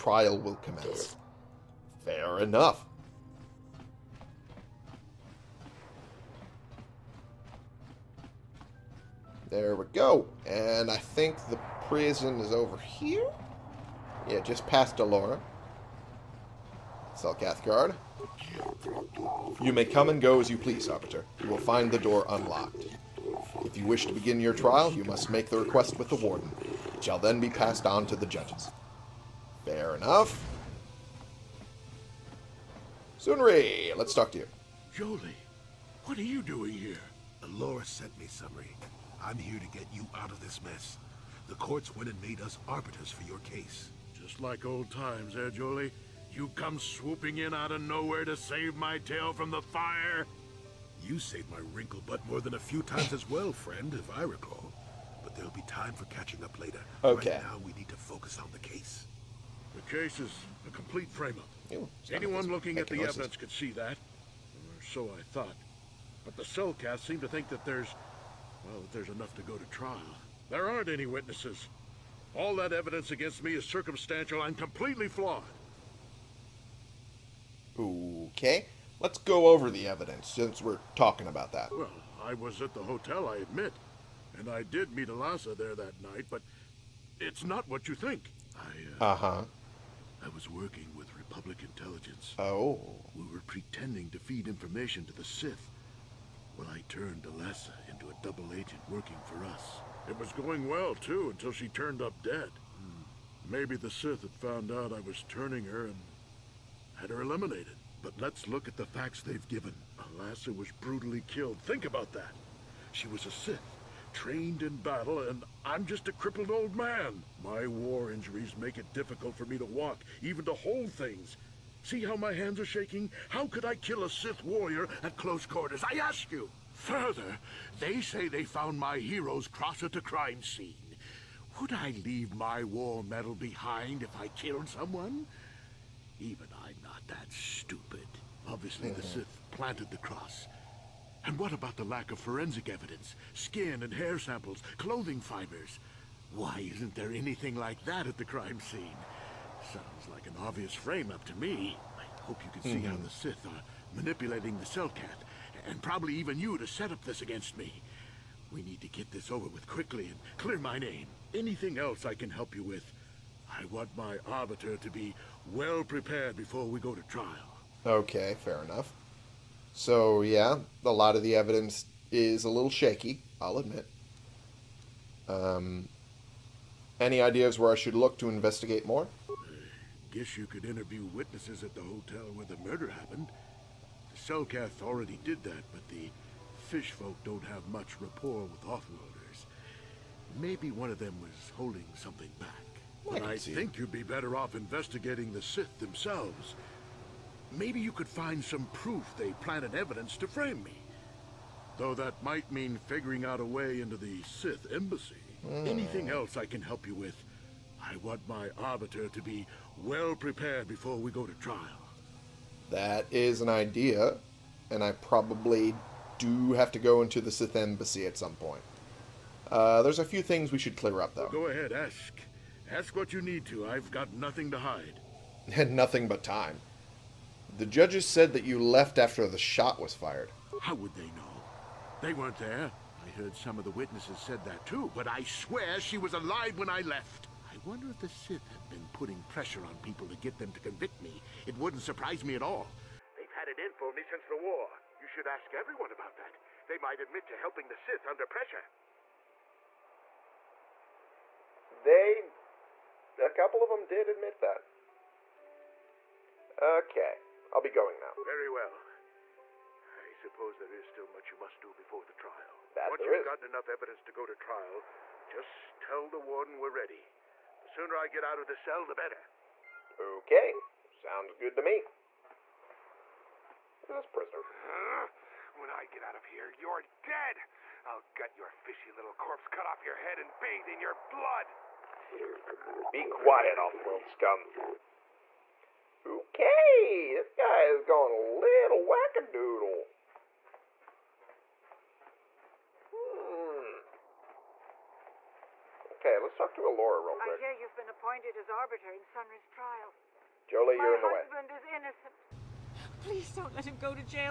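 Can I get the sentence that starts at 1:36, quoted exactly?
Well, I turned Elassa into a double agent working for us.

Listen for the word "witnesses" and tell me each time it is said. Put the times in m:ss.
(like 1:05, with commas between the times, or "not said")
1:11, 3:01, 3:53.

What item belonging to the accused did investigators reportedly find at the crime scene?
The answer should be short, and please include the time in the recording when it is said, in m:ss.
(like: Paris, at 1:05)
Heroes cross, at 2:08.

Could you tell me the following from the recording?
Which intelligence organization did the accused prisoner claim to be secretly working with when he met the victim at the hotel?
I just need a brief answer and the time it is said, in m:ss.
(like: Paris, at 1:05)
Republic Intelligence, at 1:31.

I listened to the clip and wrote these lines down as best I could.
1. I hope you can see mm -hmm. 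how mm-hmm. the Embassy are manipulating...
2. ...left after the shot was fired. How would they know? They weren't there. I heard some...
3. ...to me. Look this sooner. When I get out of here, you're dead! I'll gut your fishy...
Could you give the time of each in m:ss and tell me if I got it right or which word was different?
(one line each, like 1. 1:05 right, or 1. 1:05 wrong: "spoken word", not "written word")
1. 2:31 wrong: "Sith", not "Embassy"
2. 3:48 right
3. 4:31 wrong: "prisoner", not "sooner".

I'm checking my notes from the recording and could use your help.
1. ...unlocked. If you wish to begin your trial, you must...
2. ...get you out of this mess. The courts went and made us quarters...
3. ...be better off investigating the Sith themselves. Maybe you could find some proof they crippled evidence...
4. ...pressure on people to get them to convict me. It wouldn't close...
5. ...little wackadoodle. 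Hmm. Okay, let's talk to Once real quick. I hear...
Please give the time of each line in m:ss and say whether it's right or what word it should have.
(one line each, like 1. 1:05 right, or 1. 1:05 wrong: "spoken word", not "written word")
1. 0:22 right
2. 0:39 wrong: "arbiters", not "quarters"
3. 3:13 wrong: "planted", not "crippled"
4. 3:59 wrong: "surprise", not "close"
5. 4:48 wrong: "Elora", not "Once".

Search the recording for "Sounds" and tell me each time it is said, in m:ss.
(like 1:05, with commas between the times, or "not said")
2:29, 4:30.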